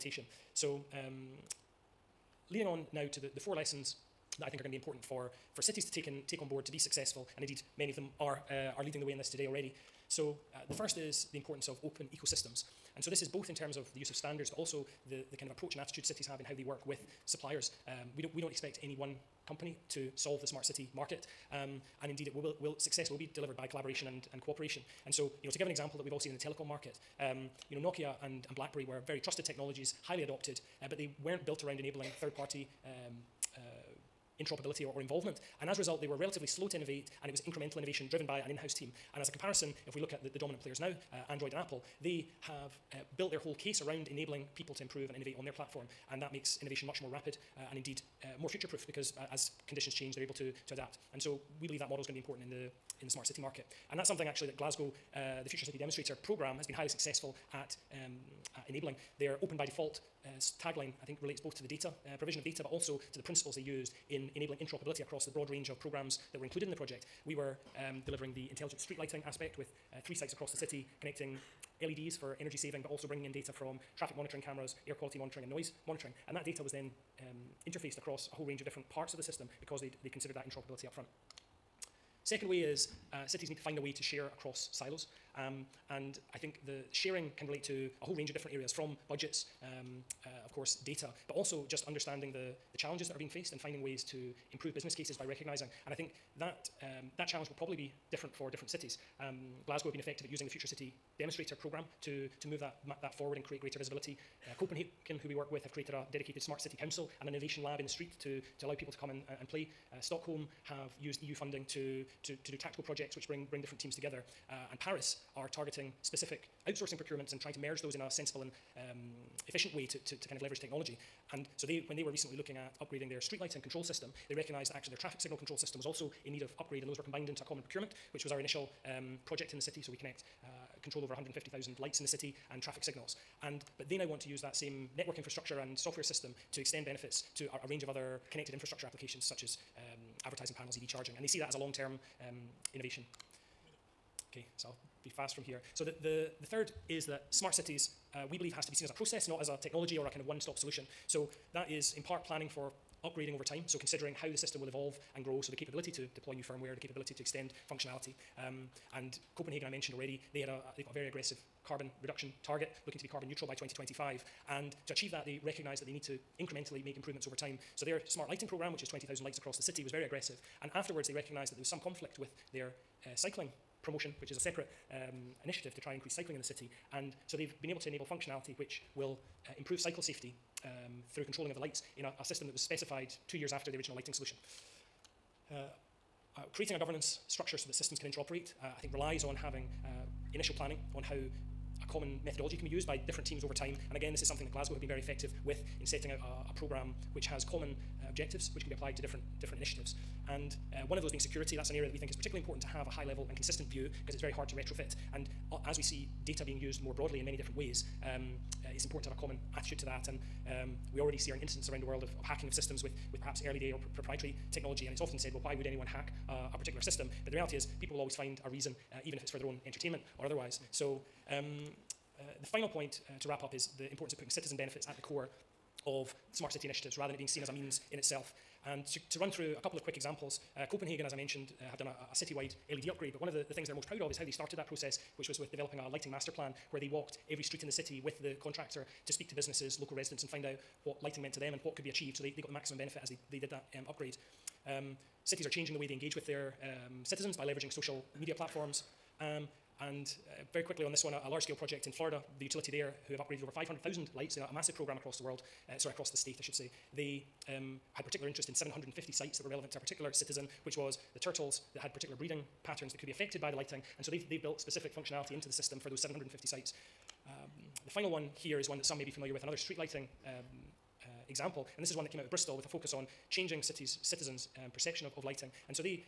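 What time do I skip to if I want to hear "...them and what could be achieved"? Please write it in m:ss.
4:01.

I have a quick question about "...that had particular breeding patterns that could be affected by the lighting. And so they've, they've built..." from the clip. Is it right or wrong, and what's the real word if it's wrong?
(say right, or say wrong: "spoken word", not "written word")
right.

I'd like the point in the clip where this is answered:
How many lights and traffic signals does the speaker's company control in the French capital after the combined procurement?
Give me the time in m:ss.
2:11.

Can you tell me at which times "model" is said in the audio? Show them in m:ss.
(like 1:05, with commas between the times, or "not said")
0:51.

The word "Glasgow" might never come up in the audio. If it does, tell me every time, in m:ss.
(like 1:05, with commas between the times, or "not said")
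0:54, 1:39, 3:14.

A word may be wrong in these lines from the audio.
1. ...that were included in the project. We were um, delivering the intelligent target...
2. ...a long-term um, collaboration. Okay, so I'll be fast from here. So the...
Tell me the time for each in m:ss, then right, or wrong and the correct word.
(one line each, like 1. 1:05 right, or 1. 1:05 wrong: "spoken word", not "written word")
1. 1:06 wrong: "street", not "target"
2. 2:21 wrong: "innovation", not "collaboration".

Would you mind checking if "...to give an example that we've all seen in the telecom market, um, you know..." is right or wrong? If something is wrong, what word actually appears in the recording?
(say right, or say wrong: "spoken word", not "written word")
right.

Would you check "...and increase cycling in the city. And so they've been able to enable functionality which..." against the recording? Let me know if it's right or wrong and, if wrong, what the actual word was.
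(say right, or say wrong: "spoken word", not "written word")
right.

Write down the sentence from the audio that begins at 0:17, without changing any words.
Um, we, don't, we don't expect any one company to solve the smart city market.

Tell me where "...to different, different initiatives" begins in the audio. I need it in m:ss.
3:18.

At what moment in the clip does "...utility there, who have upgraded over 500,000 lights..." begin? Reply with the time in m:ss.
4:12.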